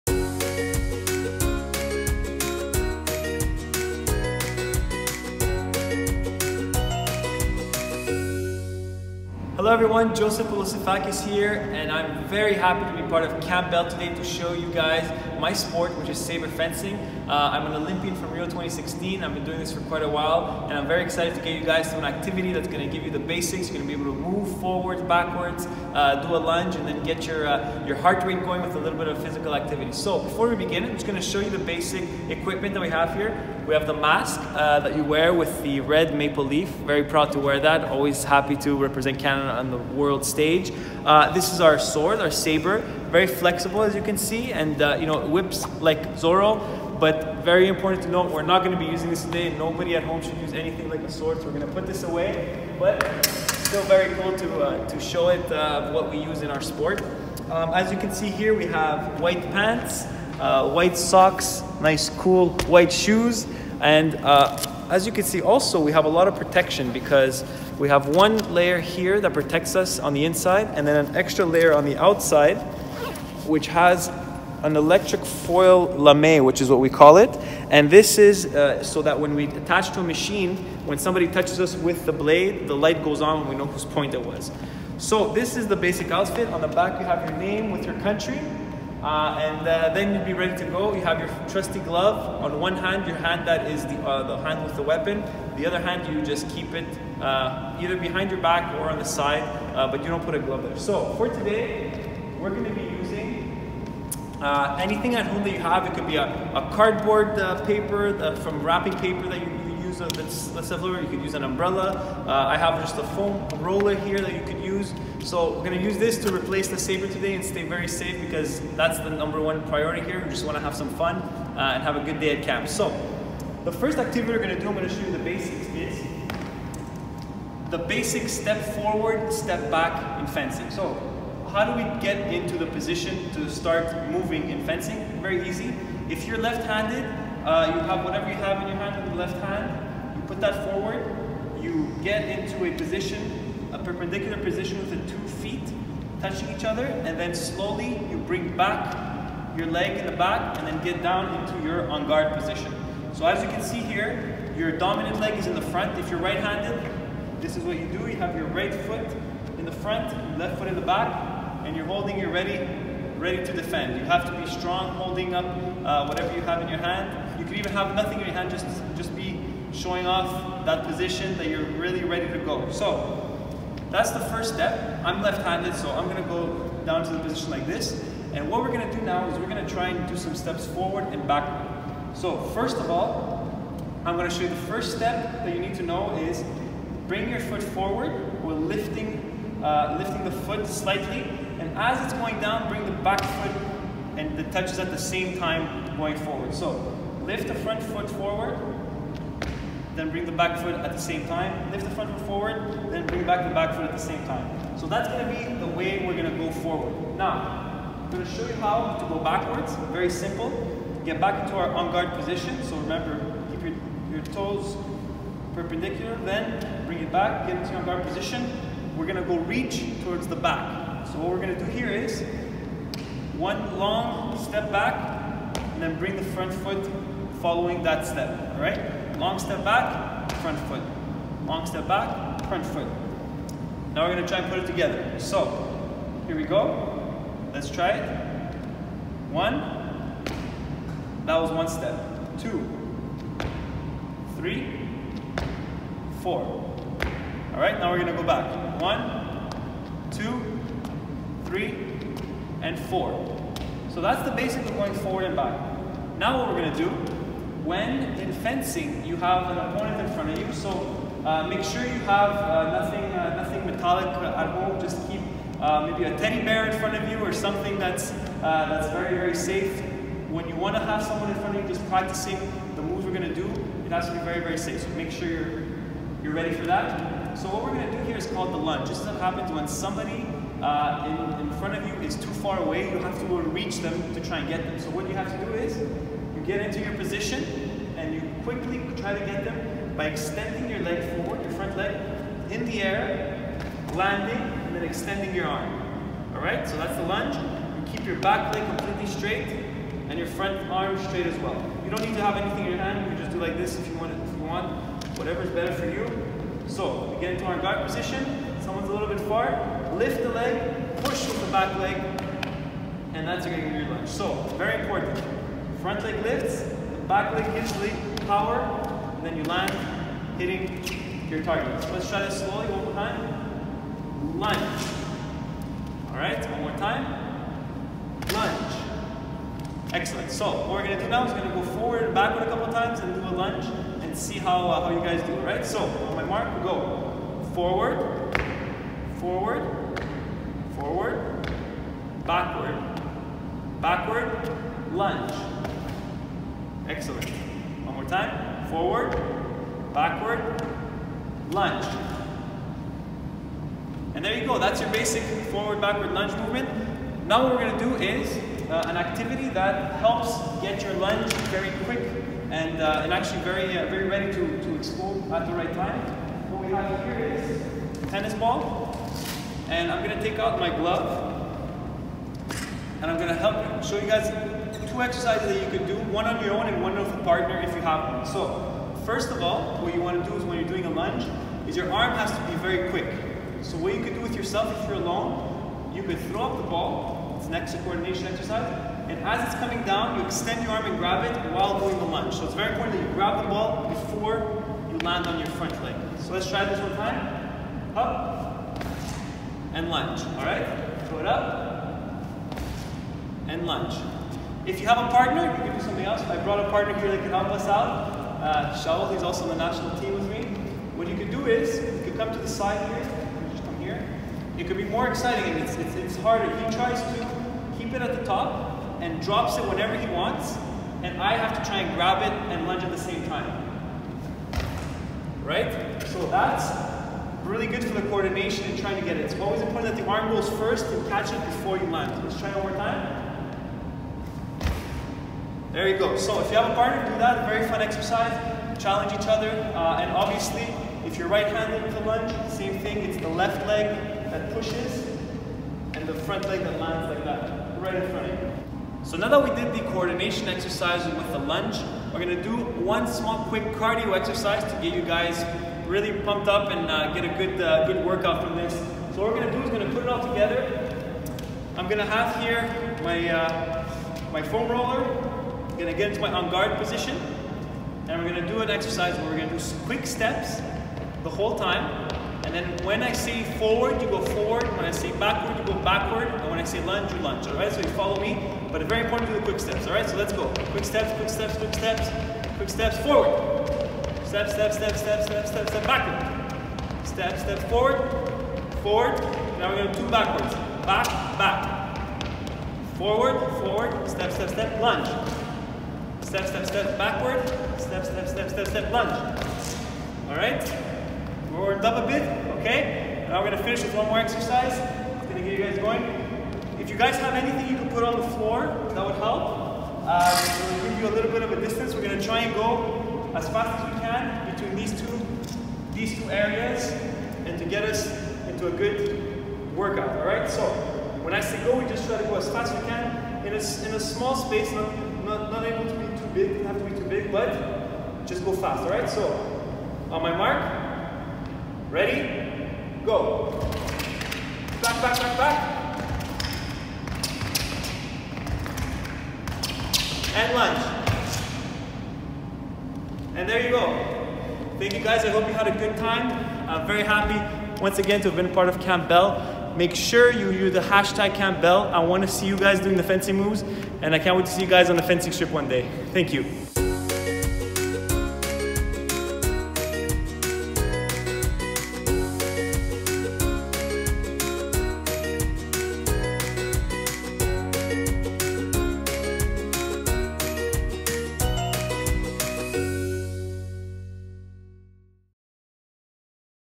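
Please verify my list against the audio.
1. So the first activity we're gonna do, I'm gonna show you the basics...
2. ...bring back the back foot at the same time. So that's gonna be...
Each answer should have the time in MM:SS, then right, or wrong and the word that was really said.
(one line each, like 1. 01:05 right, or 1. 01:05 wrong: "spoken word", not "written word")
1. 02:02 right
2. 03:23 right.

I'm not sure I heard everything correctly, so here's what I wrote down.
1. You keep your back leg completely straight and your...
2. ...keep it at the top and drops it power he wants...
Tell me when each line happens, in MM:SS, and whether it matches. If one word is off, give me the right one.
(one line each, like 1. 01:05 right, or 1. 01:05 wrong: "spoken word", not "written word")
1. 04:57 right
2. 06:57 wrong: "whenever", not "power".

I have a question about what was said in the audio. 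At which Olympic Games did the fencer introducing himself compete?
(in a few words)
Rio 2016.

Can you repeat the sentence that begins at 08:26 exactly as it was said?
If you guys have anything you can put on the floor, that would help.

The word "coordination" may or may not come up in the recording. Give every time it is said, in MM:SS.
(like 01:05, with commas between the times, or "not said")
06:27, 07:08, 07:29.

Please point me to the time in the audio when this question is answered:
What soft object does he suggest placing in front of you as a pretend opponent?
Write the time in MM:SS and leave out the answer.
04:26.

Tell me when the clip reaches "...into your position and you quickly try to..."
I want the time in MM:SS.
04:46.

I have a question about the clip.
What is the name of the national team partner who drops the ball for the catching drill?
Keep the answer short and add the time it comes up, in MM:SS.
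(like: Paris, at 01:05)
Shaul, at 06:48.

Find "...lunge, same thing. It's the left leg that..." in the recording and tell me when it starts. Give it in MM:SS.
07:22.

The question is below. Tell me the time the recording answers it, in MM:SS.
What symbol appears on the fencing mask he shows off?
00:35.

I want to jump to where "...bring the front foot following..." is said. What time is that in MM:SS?
03:45.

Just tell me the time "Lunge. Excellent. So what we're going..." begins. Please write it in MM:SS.
05:28.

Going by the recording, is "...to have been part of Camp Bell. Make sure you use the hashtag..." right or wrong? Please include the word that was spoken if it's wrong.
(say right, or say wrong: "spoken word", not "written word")
right.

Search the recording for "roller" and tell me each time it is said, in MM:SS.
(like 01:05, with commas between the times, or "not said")
01:53, 07:44.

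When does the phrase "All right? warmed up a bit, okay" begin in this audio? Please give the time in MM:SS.
08:20.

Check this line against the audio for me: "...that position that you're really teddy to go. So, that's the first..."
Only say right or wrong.
wrong.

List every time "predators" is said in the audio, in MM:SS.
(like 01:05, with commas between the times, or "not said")
not said.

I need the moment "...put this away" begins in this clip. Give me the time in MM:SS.
00:51.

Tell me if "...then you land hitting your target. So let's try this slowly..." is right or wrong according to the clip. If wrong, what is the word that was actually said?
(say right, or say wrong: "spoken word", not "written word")
right.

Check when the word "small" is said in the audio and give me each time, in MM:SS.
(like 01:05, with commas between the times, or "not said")
07:33, 08:43.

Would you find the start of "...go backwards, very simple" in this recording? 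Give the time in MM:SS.
03:29.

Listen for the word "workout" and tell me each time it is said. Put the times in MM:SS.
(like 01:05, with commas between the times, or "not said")
07:38, 08:39.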